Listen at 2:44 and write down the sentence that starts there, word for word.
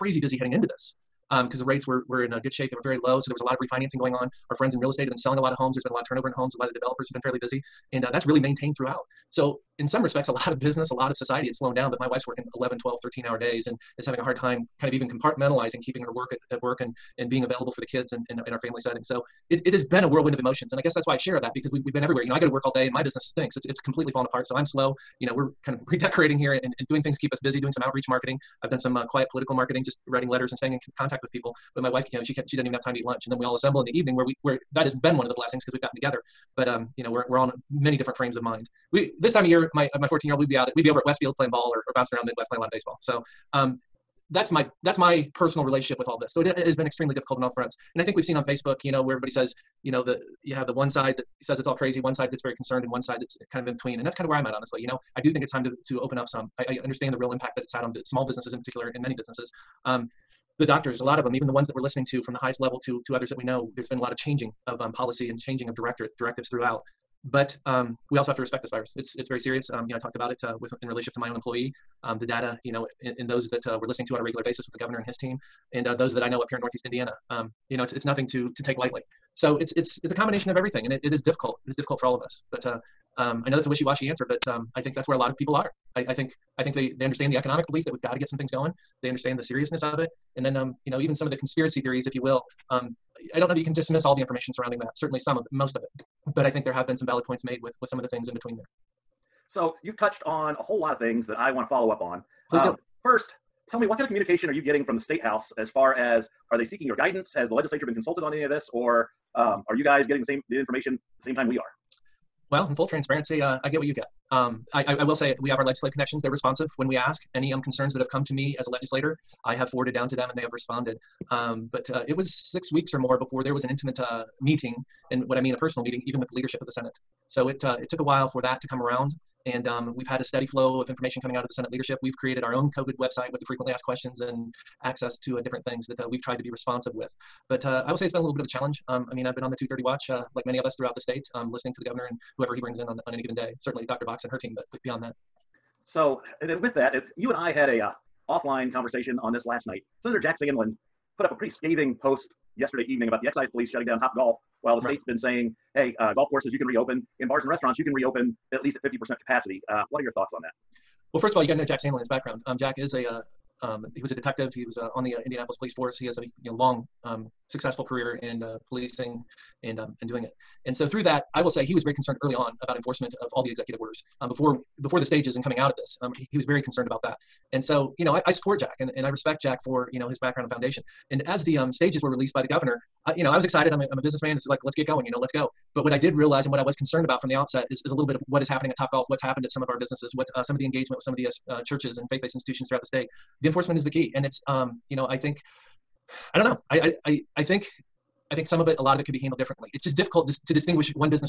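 He was uh, on the uh, Indianapolis Police Force.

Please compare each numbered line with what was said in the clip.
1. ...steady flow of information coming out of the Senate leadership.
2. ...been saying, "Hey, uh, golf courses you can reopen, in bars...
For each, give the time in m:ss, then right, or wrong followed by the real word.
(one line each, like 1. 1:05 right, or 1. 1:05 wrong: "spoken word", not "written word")
1. 2:10 right
2. 2:35 right.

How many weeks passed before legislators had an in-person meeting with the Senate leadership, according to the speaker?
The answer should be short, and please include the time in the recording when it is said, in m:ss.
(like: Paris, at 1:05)
6 weeks, at 2:02.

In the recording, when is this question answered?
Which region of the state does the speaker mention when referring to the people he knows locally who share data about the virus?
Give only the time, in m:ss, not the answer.
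1:16.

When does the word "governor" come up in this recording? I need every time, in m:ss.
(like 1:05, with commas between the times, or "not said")
1:14, 2:21, 3:02.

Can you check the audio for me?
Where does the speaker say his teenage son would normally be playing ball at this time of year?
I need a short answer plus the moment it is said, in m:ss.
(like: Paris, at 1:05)
Westfield, at 0:41.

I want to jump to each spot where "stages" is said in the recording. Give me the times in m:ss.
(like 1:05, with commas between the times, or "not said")
2:55, 3:01.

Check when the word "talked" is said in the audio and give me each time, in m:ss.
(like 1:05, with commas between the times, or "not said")
1:09.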